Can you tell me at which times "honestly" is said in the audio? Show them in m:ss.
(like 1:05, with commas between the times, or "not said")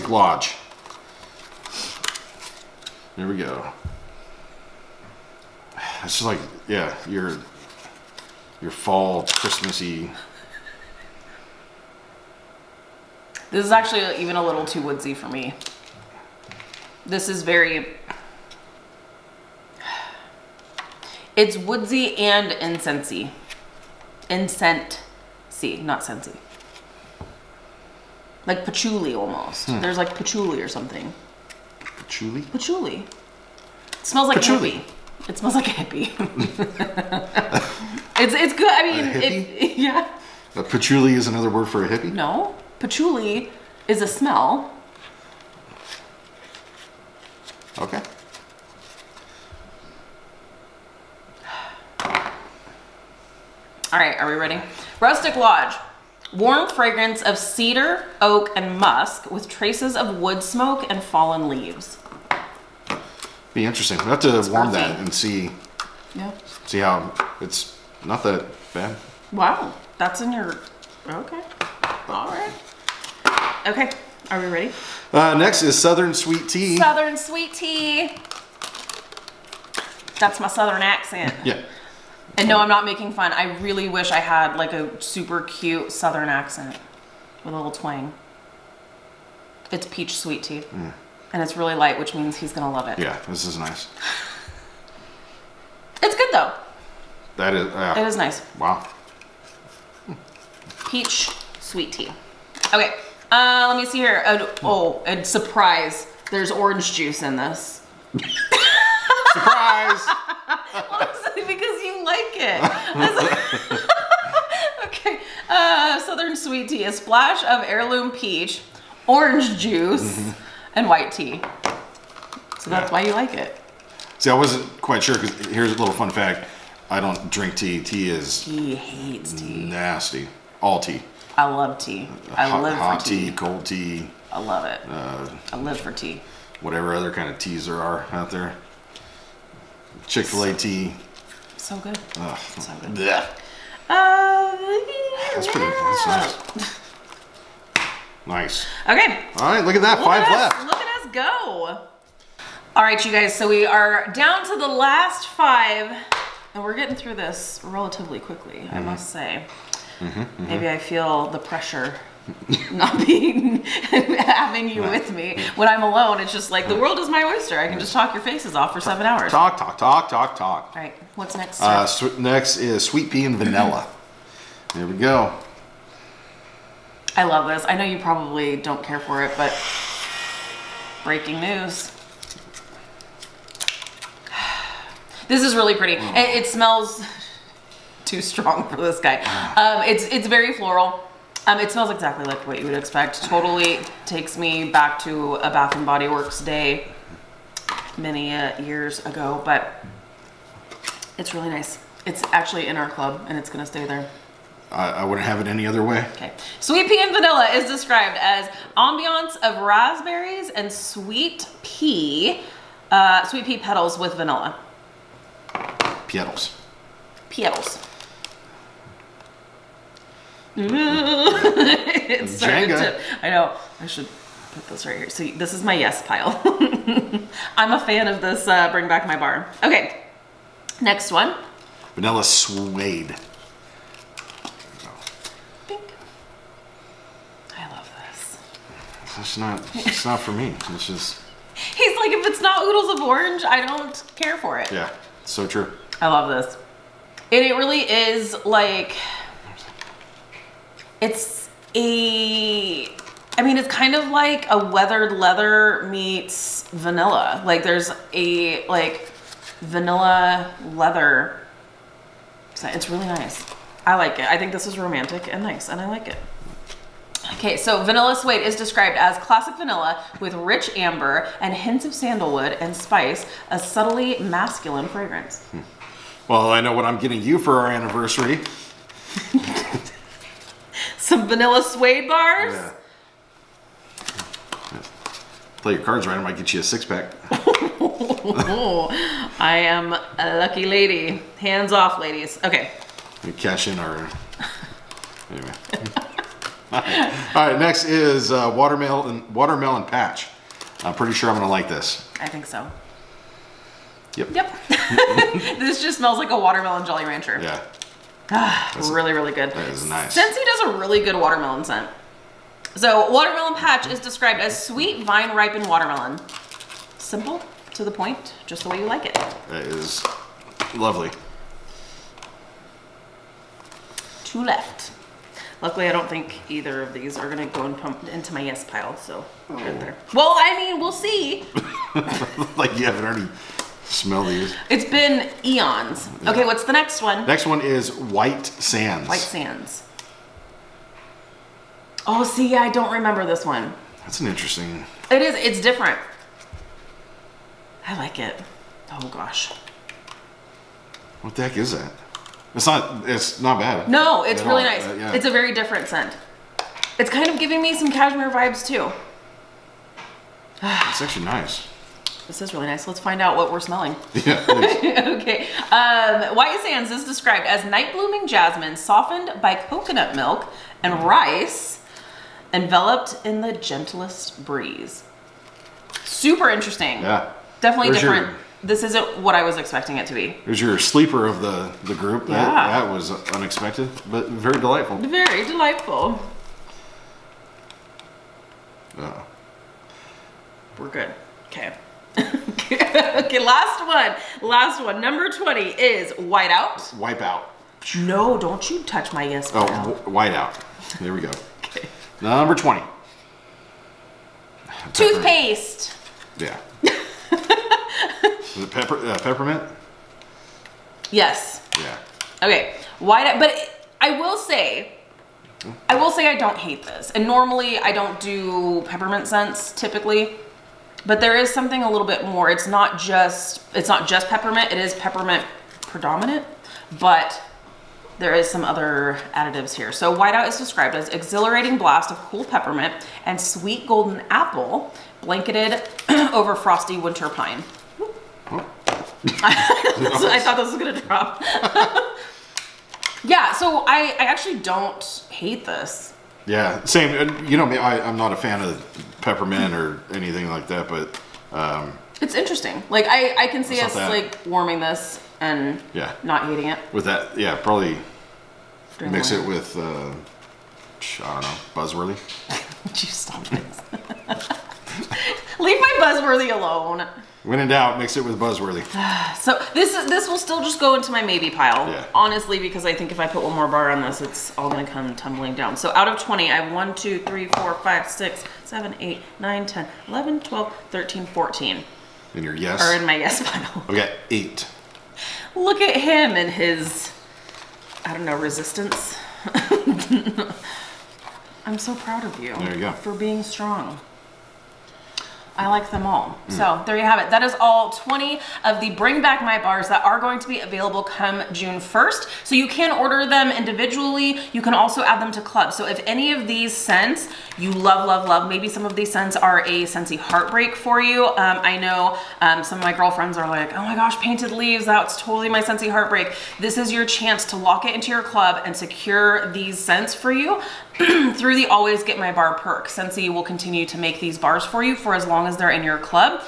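1:50, 7:52.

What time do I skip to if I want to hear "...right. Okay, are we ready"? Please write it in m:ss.
1:12.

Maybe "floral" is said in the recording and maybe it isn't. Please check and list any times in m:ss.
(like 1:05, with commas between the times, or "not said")
3:10.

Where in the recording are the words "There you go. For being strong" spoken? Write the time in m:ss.
8:12.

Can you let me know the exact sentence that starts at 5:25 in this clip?
Luckily, I don't think either of these are gonna go and pump into my yes pile, so oh.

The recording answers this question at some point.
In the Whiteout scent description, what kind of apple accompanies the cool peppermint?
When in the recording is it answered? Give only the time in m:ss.
7:13.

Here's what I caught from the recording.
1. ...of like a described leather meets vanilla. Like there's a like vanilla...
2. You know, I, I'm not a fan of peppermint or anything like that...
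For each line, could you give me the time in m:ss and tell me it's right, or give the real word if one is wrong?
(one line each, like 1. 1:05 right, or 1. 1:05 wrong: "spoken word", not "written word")
1. 4:13 wrong: "weathered", not "described"
2. 7:27 right.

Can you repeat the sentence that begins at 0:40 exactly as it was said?
A patchouli is another word for a hippie.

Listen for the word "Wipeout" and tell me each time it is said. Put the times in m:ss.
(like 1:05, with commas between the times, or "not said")
6:36.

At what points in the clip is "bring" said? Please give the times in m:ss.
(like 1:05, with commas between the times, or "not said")
3:48, 8:18.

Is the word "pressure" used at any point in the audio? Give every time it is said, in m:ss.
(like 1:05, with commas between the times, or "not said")
2:41.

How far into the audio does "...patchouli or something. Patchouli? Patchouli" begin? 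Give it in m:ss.
0:30.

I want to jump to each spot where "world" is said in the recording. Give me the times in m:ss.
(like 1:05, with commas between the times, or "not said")
2:46.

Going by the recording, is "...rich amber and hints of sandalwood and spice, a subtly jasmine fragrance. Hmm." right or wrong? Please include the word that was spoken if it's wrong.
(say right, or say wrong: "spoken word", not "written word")
wrong: "masculine", not "jasmine".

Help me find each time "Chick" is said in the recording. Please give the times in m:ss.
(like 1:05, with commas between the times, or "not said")
2:20.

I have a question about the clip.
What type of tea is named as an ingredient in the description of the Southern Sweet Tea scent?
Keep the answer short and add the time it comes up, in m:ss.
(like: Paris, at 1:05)
White tea, at 2:00.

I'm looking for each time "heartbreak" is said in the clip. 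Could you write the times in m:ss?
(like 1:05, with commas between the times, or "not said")
8:30, 8:35.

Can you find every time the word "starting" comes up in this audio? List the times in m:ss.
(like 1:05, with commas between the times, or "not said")
3:42.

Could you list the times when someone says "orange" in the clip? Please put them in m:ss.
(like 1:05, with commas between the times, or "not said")
1:46, 1:59, 4:03.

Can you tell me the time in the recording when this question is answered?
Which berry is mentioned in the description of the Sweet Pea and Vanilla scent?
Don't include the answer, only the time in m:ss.
3:29.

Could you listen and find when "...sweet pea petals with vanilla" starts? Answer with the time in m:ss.
3:33.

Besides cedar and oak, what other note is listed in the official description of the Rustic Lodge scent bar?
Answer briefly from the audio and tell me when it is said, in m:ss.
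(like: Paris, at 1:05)
Musk, at 0:58.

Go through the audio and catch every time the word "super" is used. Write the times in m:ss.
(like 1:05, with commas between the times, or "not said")
1:25, 6:16.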